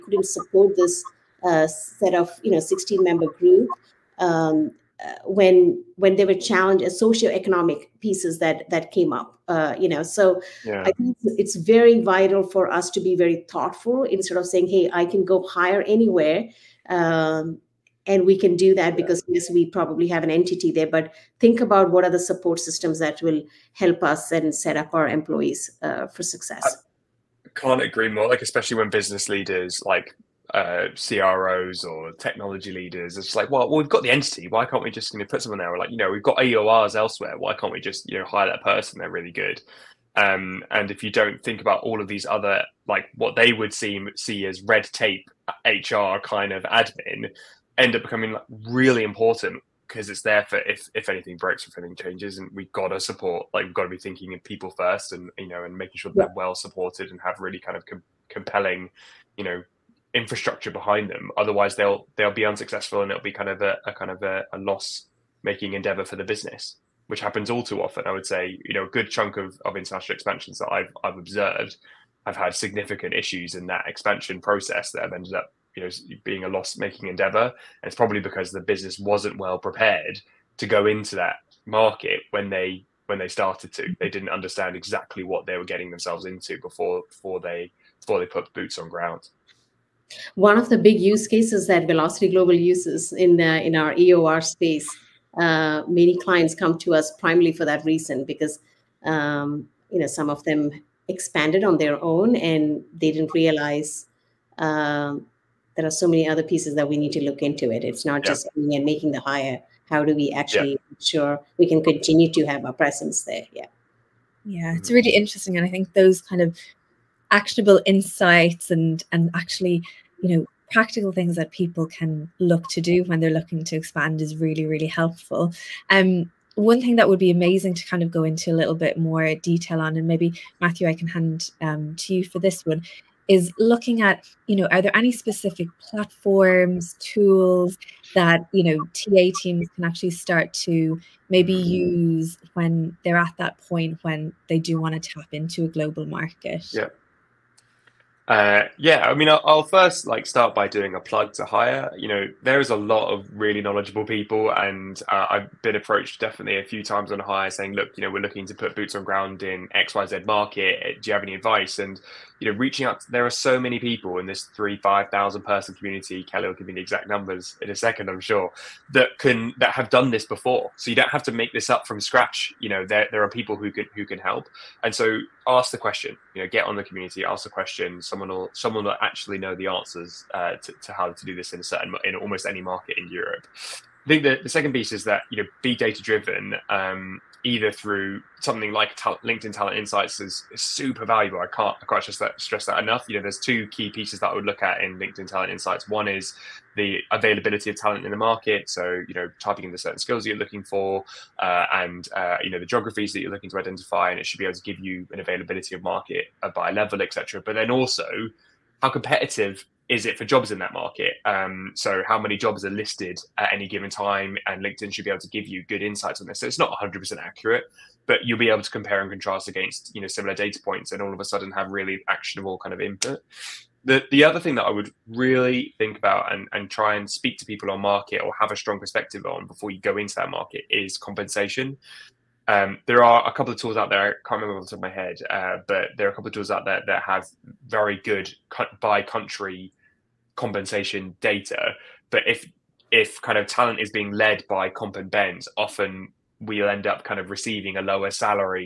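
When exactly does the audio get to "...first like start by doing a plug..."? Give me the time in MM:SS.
02:29.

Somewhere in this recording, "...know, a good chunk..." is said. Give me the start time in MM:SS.
01:08.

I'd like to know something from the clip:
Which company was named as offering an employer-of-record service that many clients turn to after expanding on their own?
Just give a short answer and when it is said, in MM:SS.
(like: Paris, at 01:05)
Velocity Global, at 01:31.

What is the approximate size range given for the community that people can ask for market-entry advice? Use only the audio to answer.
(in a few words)
3,000 to 5,000 people.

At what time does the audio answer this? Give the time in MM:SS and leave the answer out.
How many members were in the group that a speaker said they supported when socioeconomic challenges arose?
00:02.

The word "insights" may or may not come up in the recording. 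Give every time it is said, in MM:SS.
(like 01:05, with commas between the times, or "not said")
01:57, 03:09, 03:15, 03:35.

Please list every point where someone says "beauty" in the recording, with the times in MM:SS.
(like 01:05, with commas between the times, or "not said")
not said.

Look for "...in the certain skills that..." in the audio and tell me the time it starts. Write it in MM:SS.
03:19.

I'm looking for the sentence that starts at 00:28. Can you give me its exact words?
Like especially when business leaders, like uh, CROs or technology leaders, it's like, well, well, we've got the entity.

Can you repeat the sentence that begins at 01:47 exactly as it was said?
It's not just and making the hire.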